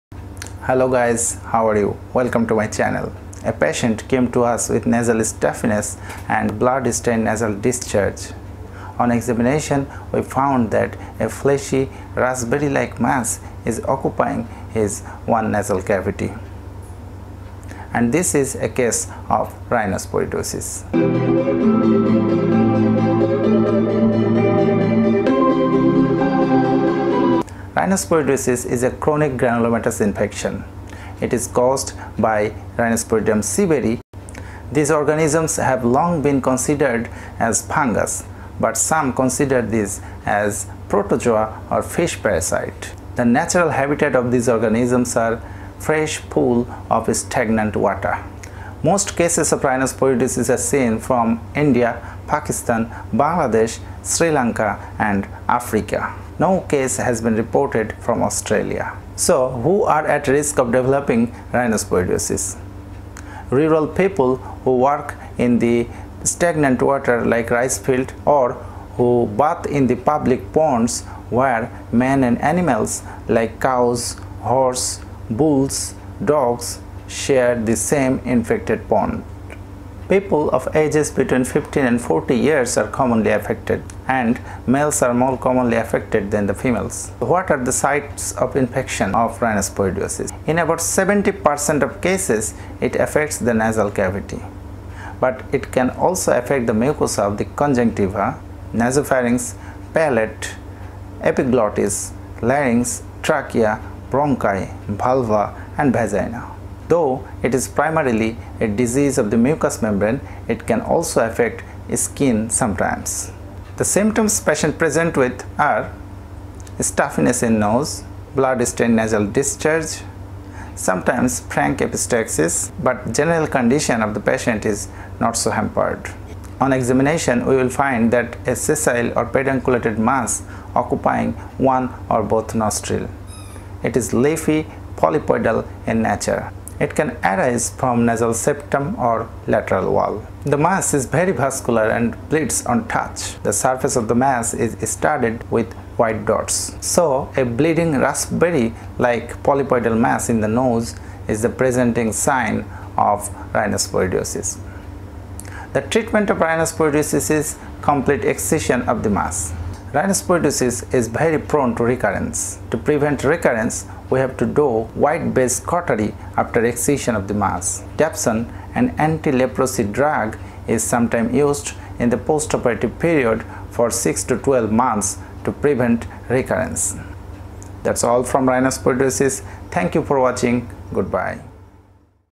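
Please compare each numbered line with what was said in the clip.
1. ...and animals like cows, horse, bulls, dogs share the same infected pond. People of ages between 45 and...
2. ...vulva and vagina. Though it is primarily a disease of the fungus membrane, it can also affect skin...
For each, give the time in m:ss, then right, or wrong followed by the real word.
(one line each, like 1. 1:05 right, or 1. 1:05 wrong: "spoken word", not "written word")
1. 1:12 wrong: "15", not "45"
2. 1:44 wrong: "mucous", not "fungus".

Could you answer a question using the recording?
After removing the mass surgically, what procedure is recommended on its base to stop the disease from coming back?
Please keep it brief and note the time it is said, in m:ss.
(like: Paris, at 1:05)
Wide-based cautery, at 2:44.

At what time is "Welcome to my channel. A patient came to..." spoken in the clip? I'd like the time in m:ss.
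0:02.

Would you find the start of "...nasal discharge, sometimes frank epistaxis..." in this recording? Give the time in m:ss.
1:58.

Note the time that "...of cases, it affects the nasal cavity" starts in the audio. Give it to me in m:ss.
1:31.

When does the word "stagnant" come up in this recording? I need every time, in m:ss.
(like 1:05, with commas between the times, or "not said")
0:47, 1:06.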